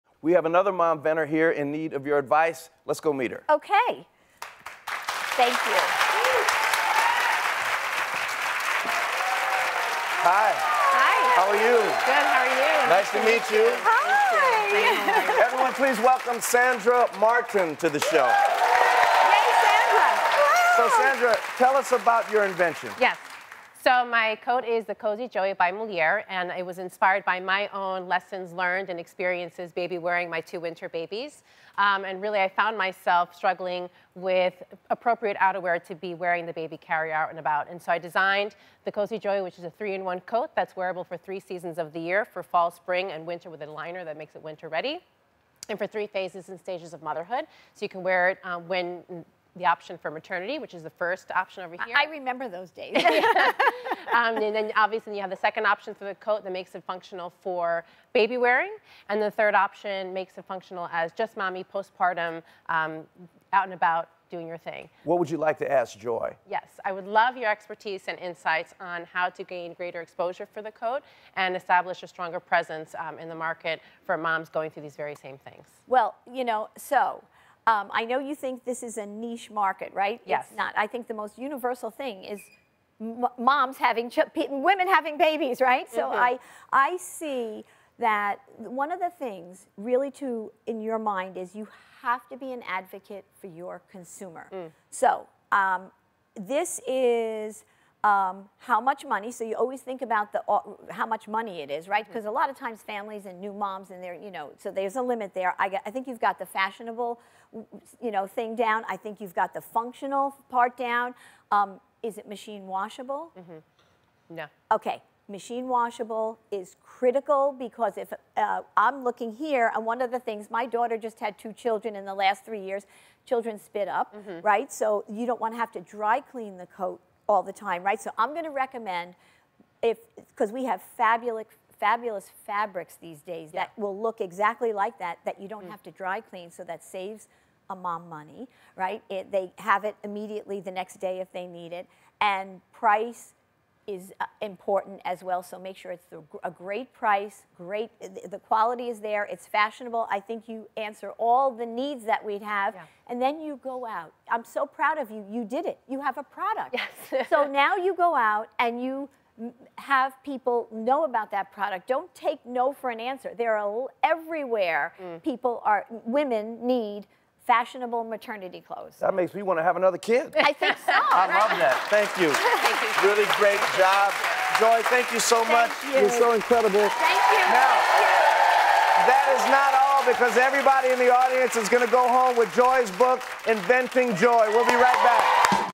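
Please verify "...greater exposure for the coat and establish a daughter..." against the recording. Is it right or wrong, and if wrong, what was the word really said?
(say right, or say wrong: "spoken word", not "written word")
wrong: "stronger", not "daughter".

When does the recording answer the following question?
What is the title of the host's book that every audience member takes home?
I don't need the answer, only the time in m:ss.
3:03.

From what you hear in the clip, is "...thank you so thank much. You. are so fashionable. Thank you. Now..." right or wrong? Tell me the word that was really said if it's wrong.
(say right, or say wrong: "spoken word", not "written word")
wrong: "incredible", not "fashionable".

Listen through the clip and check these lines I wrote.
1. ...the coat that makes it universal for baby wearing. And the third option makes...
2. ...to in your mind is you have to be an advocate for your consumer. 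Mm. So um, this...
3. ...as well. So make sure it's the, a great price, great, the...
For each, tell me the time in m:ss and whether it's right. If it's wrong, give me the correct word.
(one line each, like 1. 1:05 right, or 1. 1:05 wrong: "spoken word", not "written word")
1. 0:56 wrong: "functional", not "universal"
2. 1:30 right
3. 2:25 right.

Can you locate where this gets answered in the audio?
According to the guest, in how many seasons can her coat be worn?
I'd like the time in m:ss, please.
0:41.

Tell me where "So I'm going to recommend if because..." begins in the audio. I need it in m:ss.
2:08.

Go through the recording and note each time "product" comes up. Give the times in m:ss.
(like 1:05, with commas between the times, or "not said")
2:36, 2:41.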